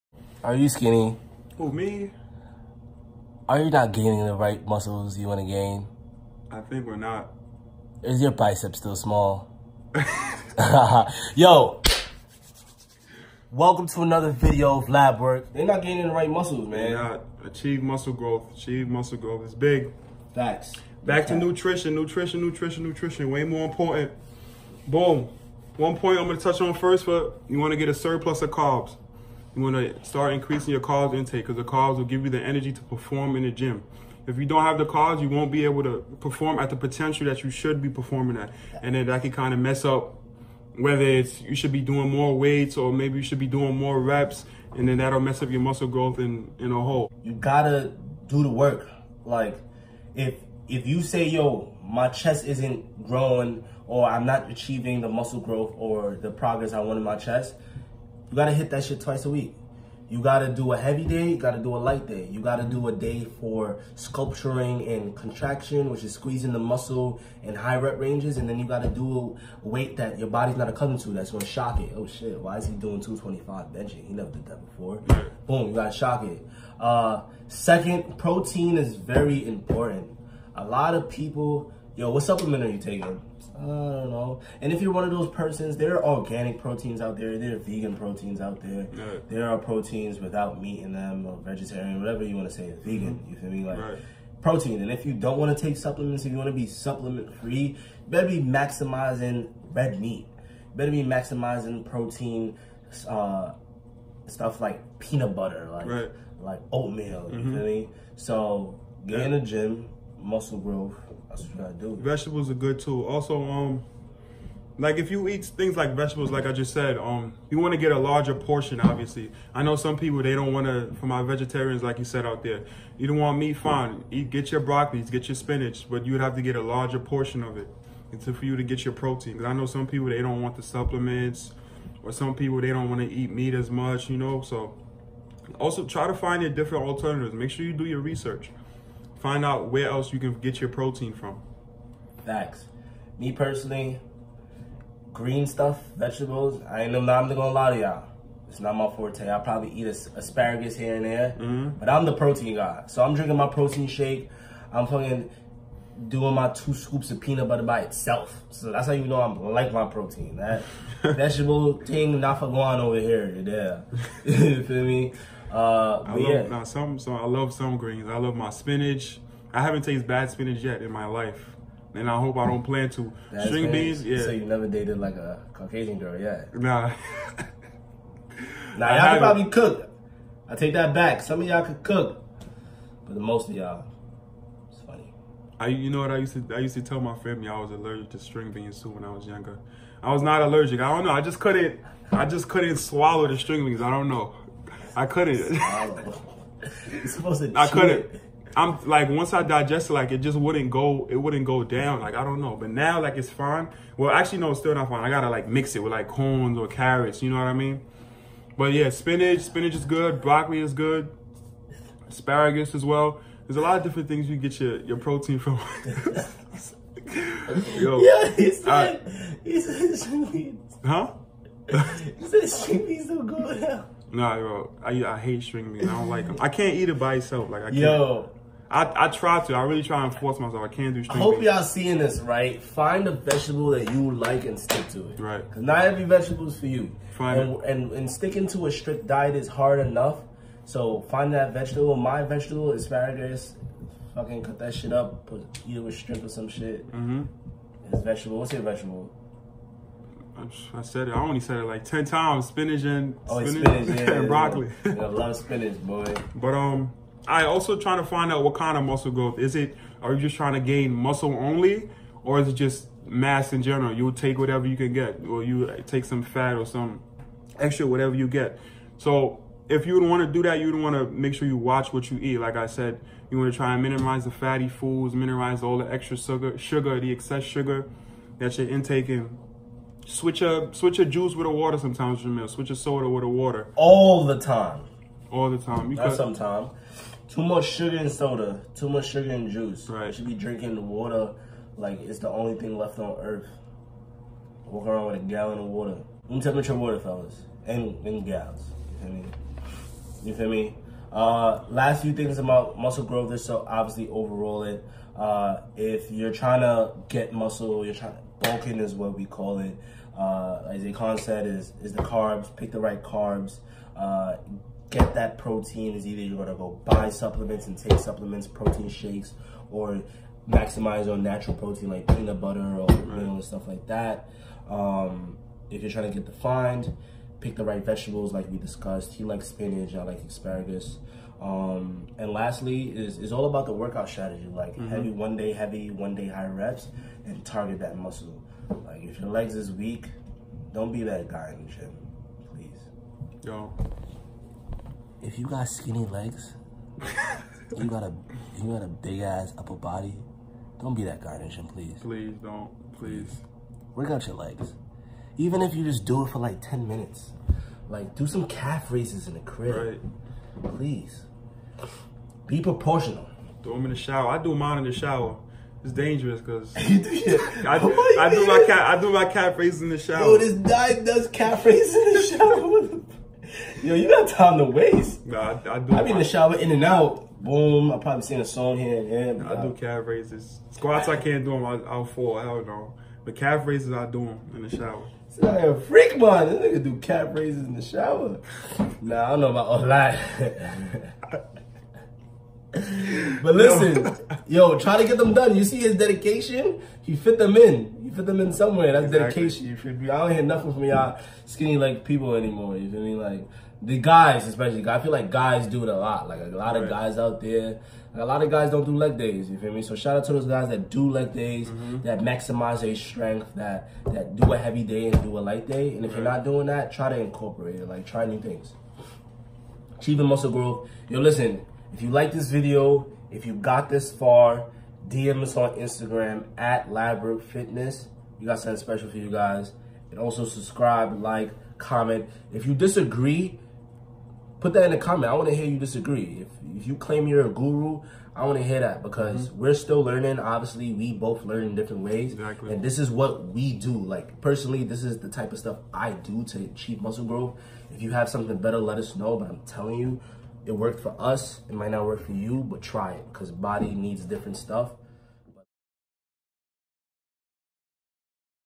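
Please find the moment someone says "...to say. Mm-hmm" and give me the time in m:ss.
1:32.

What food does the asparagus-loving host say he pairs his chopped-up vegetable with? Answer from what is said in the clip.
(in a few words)
Shrimp.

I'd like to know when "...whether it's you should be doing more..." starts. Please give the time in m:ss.
0:40.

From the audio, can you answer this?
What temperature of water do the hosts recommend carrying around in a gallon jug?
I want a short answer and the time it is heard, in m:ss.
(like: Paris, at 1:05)
Room temperature, at 4:56.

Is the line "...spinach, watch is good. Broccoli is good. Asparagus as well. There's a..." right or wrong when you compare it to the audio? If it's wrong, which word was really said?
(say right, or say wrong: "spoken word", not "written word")
wrong: "spinach", not "watch".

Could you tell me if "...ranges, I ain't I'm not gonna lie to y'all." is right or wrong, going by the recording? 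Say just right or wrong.
wrong.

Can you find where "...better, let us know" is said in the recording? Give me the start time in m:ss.
7:28.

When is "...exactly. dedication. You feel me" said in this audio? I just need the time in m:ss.
6:39.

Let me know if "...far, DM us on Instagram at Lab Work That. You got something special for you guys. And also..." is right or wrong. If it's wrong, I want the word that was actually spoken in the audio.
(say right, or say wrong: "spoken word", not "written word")
wrong: "Fitness", not "That".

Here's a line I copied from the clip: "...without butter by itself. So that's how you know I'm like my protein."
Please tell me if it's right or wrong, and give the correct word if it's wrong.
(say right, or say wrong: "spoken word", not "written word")
wrong: "peanut", not "without".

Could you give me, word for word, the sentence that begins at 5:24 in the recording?
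Um, if you're trying to get defined, pick the right vegetables like we discussed.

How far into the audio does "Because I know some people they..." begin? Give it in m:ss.
2:09.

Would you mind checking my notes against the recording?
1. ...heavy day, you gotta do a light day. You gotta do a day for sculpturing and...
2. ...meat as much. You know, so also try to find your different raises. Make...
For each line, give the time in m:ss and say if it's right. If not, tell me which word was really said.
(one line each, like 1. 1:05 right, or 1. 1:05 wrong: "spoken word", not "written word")
1. 1:00 right
2. 2:13 wrong: "alternatives", not "raises".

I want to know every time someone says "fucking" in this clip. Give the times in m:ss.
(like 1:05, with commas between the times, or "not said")
2:34, 4:04.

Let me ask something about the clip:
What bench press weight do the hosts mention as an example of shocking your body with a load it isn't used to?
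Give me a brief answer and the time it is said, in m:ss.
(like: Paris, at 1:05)
225, at 1:13.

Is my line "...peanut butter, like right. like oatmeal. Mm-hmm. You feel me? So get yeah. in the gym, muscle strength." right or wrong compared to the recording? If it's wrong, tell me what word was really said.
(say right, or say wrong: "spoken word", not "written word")
wrong: "growth", not "strength".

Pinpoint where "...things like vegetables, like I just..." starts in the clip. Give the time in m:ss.
1:55.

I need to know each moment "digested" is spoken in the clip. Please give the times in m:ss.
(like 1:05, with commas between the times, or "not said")
3:19.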